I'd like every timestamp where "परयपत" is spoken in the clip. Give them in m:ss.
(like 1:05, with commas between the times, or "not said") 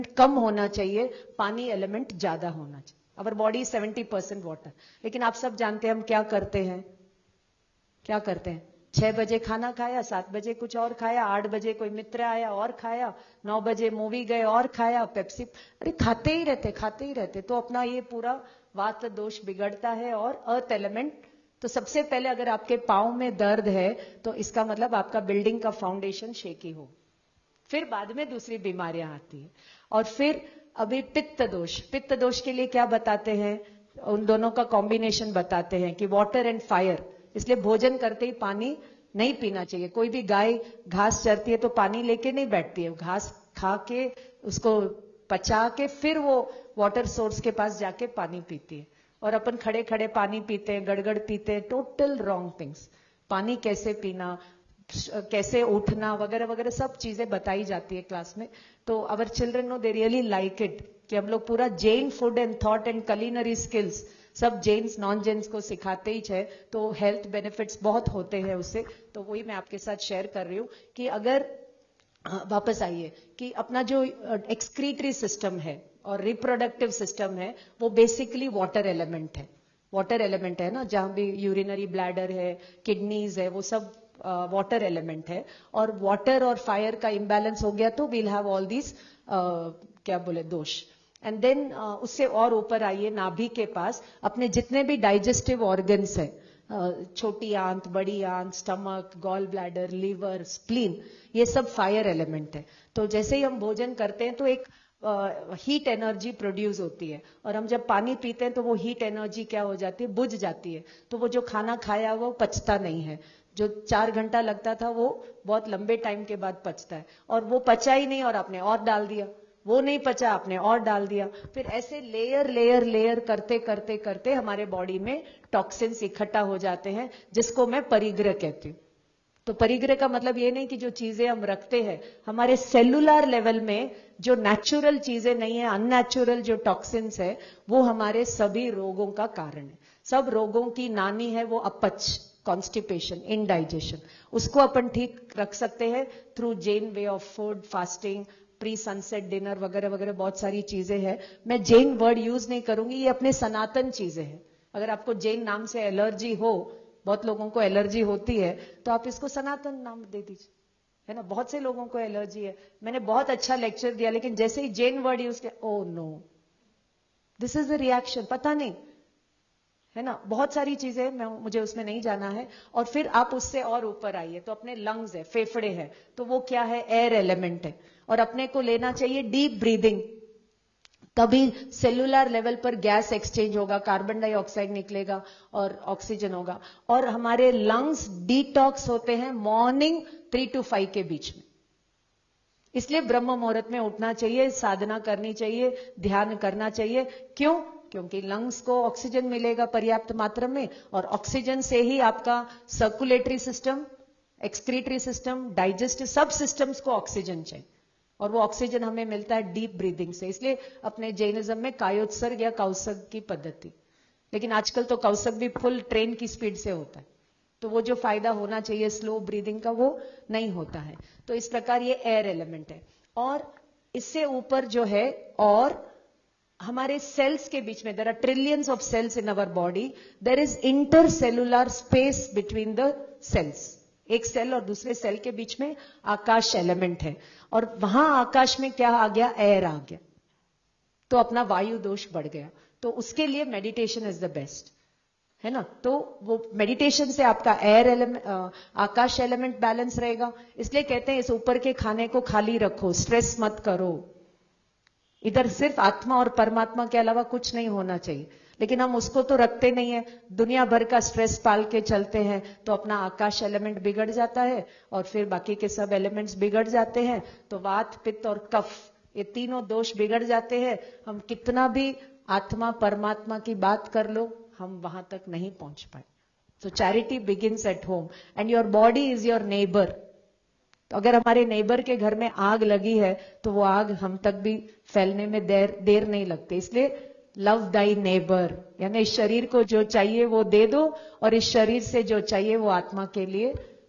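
3:19.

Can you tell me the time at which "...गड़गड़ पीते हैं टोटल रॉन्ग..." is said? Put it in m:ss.
0:50.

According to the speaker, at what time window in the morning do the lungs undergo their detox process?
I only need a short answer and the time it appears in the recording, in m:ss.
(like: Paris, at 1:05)
3 to 5, at 3:10.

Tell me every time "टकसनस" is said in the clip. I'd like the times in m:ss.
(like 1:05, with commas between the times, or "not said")
2:05, 2:16.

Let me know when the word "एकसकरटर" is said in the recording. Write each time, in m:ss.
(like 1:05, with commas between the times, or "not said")
1:14, 3:24.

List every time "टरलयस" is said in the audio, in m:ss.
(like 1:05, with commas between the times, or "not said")
3:48.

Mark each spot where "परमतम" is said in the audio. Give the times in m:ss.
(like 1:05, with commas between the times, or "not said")
4:16, 4:32.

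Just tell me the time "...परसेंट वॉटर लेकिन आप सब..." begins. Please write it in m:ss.
0:04.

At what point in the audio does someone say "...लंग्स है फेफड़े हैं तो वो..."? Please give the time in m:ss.
2:54.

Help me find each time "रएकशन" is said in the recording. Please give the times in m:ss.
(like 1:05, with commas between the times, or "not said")
2:47.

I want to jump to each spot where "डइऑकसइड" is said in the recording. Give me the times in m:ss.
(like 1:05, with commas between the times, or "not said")
3:04.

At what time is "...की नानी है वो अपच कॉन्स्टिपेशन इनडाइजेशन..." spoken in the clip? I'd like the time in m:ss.
2:20.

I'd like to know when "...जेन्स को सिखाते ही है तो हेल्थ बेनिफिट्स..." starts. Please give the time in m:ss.
1:05.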